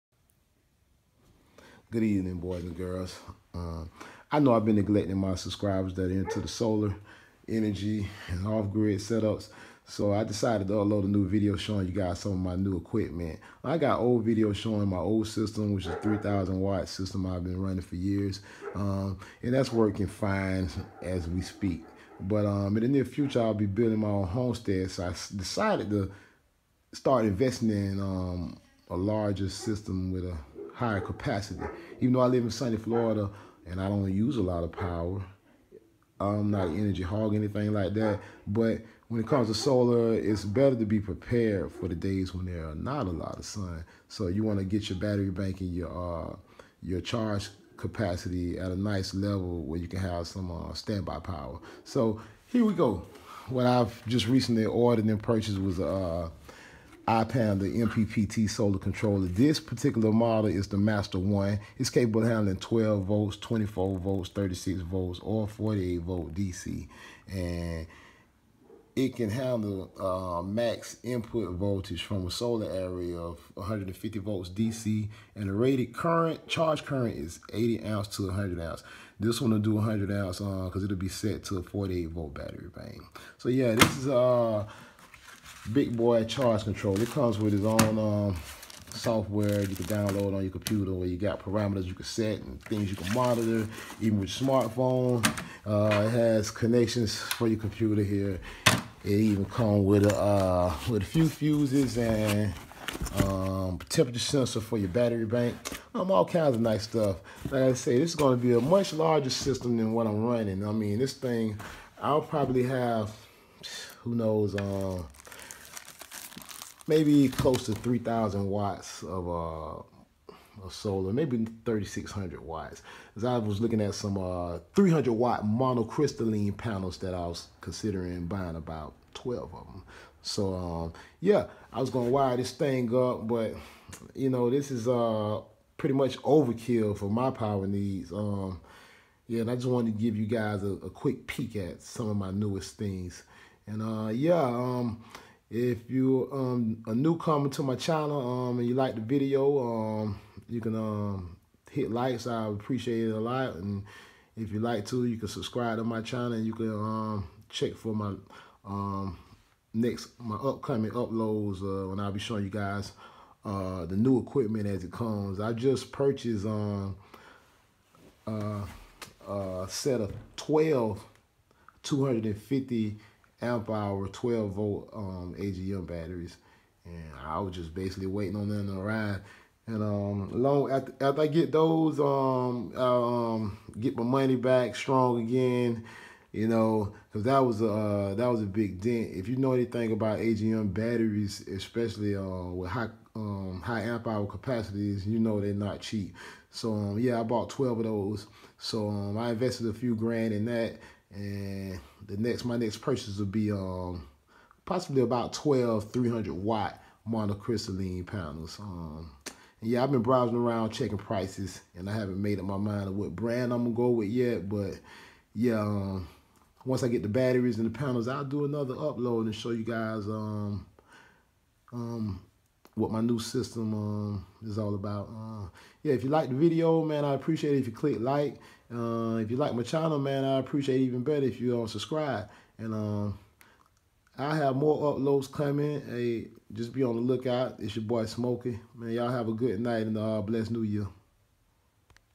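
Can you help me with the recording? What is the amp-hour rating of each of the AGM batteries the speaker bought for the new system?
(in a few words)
250.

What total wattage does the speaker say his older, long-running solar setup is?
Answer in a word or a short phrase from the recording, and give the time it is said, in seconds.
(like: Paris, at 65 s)
3,000 watts, at 16 s.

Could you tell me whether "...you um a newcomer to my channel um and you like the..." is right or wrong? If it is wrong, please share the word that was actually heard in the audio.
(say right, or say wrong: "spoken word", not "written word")
right.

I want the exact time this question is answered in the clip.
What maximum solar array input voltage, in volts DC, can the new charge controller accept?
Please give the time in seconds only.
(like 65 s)
73 s.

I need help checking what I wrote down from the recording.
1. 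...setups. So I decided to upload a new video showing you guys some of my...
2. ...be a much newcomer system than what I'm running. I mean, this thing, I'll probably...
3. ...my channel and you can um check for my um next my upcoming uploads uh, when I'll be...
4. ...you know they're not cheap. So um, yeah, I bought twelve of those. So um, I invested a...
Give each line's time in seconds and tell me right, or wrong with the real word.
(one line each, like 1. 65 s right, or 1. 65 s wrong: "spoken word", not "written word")
1. 8 s right
2. 108 s wrong: "larger", not "newcomer"
3. 155 s right
4. 195 s right.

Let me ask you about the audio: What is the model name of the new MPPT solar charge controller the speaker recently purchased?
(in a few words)
Master 1.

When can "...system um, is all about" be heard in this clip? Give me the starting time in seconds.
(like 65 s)
223 s.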